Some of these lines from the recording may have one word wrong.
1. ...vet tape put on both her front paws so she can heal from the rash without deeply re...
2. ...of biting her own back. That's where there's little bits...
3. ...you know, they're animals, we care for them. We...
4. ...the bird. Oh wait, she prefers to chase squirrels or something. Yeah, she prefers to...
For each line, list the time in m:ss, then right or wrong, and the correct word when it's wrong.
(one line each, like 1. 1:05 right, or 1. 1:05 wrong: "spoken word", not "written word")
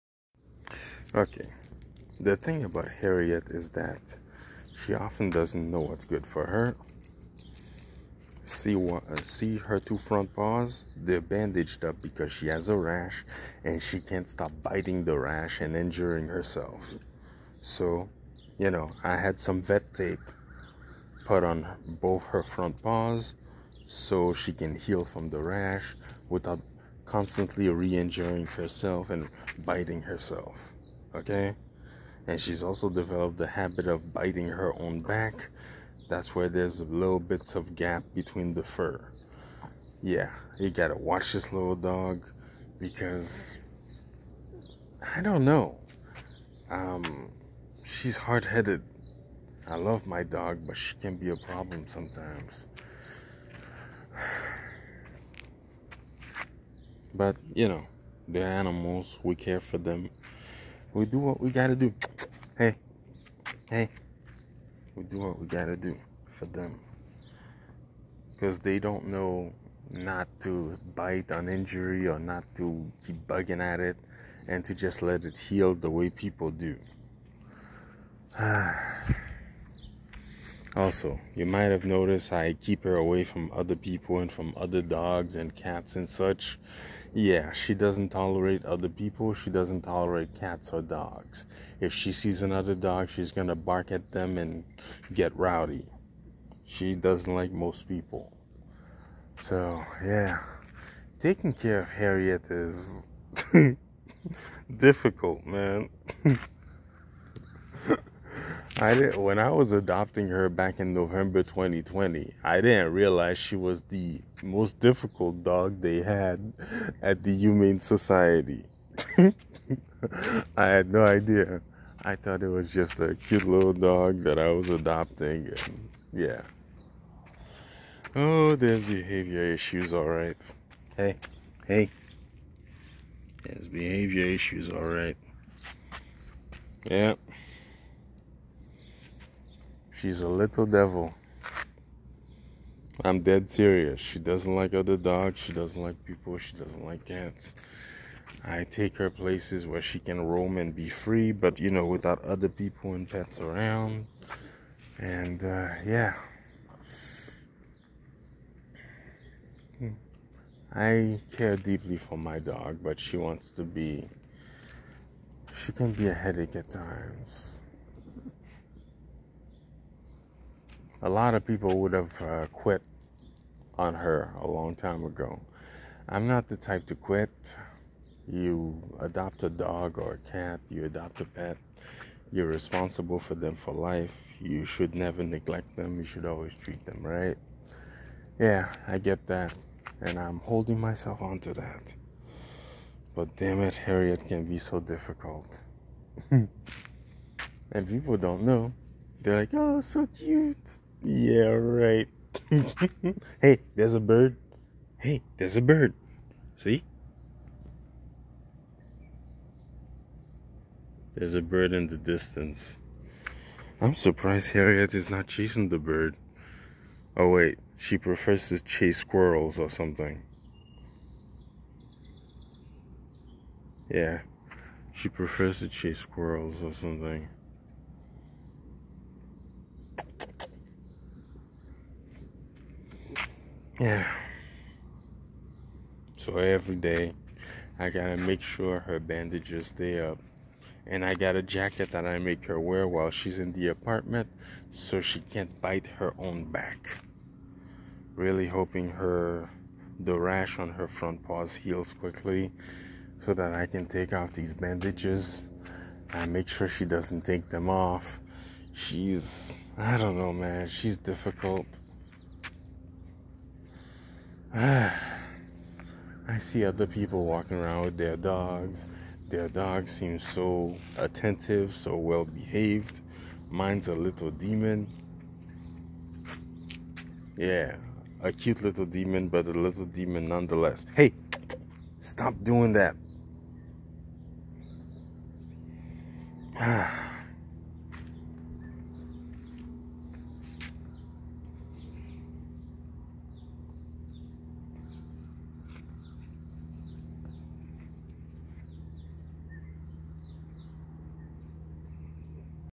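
1. 0:19 wrong: "constantly", not "deeply"
2. 0:33 right
3. 0:57 right
4. 3:35 right.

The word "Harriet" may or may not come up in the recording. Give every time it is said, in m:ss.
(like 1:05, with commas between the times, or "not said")
0:02, 1:41, 3:13, 3:34.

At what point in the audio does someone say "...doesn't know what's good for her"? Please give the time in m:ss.
0:05.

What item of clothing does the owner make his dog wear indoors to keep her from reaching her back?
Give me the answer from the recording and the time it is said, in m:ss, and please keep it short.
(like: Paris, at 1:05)
jacket, at 4:01.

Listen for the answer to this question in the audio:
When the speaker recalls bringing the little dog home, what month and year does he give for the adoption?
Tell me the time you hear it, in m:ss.
1:50.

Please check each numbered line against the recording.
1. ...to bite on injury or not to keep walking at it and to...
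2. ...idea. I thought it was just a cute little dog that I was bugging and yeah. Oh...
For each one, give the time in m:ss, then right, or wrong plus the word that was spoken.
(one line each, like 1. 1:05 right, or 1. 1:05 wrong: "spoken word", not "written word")
1. 1:10 wrong: "bugging", not "walking"
2. 2:01 wrong: "adopting", not "bugging".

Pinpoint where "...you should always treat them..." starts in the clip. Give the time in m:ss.
3:05.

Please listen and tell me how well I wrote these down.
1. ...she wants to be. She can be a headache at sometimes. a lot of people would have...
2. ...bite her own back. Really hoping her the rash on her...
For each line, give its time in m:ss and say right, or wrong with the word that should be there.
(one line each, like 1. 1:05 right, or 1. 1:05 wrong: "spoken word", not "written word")
1. 2:42 wrong: "times", not "sometimes"
2. 4:05 right.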